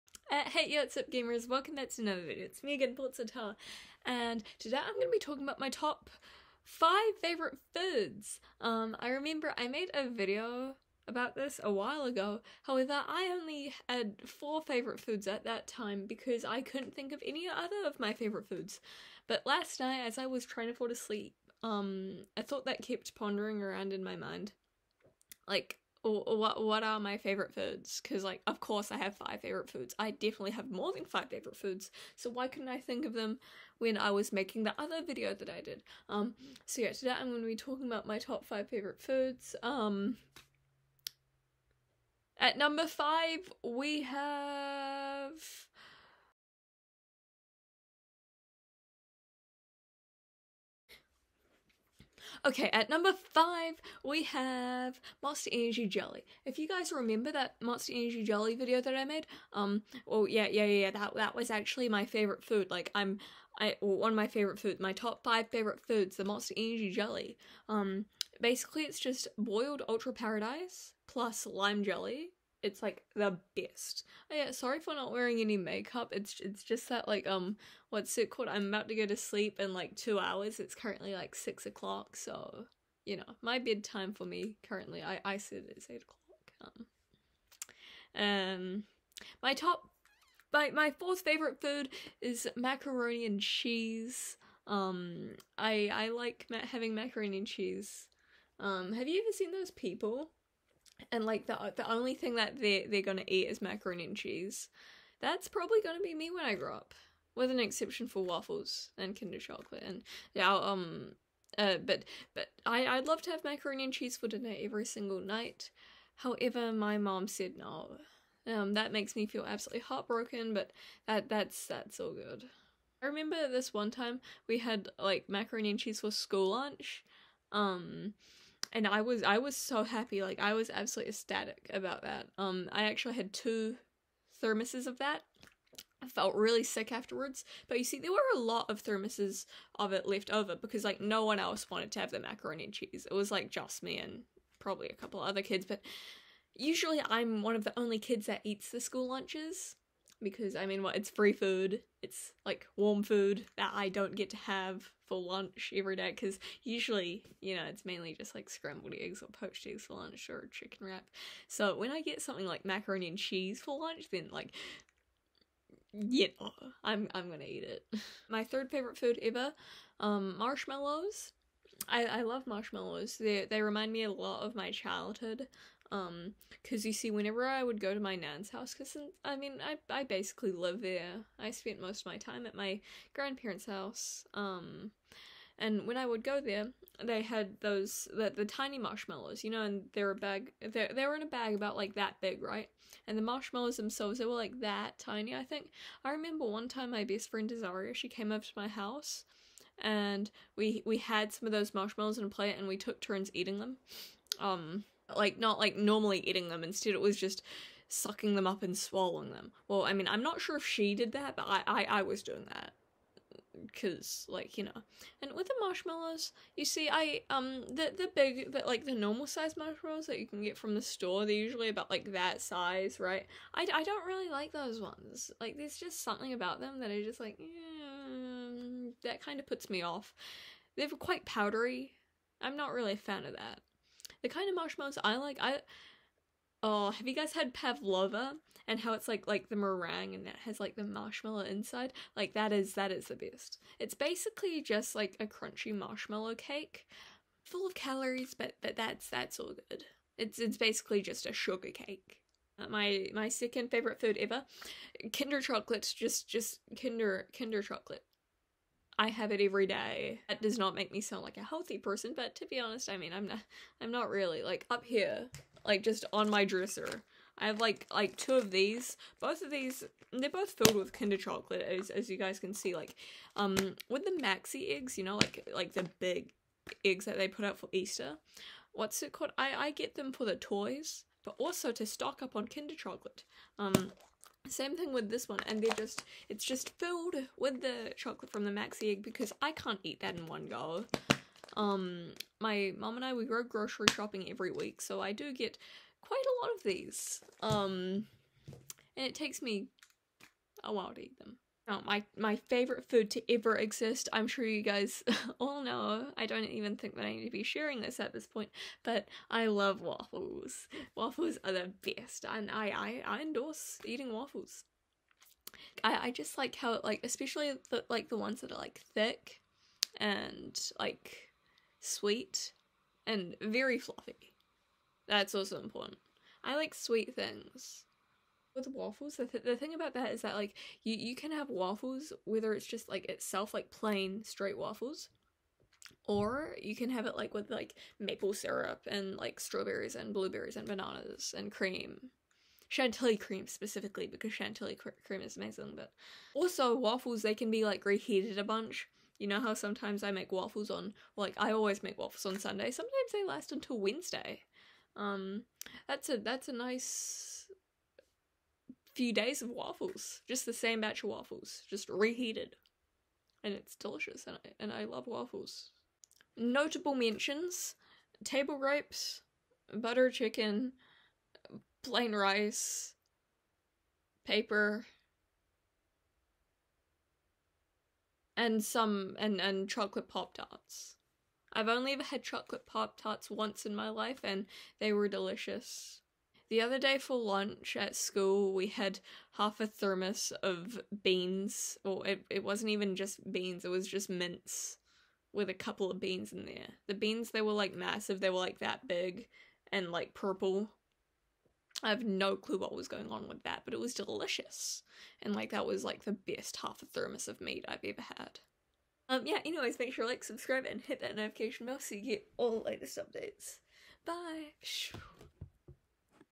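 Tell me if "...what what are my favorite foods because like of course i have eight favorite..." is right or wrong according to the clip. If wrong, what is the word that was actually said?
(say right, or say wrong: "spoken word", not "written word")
wrong: "five", not "eight".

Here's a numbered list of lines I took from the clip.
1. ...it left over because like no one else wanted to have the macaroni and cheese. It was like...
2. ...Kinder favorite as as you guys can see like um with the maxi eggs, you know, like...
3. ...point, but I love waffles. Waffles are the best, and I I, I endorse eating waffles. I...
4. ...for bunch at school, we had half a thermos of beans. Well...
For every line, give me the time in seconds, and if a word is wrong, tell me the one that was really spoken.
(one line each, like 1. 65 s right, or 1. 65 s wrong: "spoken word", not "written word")
1. 139 s right
2. 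270 s wrong: "chocolate", not "favorite"
3. 308 s right
4. 386 s wrong: "lunch", not "bunch".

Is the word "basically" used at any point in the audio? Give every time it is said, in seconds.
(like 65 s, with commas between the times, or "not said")
68 s, 180 s, 243 s, 250 s.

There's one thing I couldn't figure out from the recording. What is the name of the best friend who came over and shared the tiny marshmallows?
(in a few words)
Azaria.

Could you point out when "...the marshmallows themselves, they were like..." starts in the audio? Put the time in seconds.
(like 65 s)
193 s.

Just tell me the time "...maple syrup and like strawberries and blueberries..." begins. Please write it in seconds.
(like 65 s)
337 s.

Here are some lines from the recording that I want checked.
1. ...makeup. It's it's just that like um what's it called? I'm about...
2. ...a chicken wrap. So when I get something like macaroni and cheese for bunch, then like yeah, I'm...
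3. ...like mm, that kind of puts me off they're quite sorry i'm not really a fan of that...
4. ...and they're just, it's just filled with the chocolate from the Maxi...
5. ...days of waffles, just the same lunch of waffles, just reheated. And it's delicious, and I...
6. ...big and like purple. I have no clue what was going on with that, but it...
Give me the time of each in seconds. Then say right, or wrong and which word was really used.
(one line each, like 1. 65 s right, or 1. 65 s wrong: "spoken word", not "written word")
1. 75 s right
2. 160 s wrong: "lunch", not "bunch"
3. 227 s wrong: "powdery", not "sorry"
4. 285 s right
5. 359 s wrong: "batch", not "lunch"
6. 398 s right.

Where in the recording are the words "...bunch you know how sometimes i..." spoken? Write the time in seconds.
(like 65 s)
348 s.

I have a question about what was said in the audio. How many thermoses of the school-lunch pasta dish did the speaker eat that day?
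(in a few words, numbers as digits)
2.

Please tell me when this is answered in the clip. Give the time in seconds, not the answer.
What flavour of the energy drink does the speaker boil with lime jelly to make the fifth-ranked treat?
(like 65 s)
69 s.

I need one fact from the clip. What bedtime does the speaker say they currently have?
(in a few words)
8 o'clock.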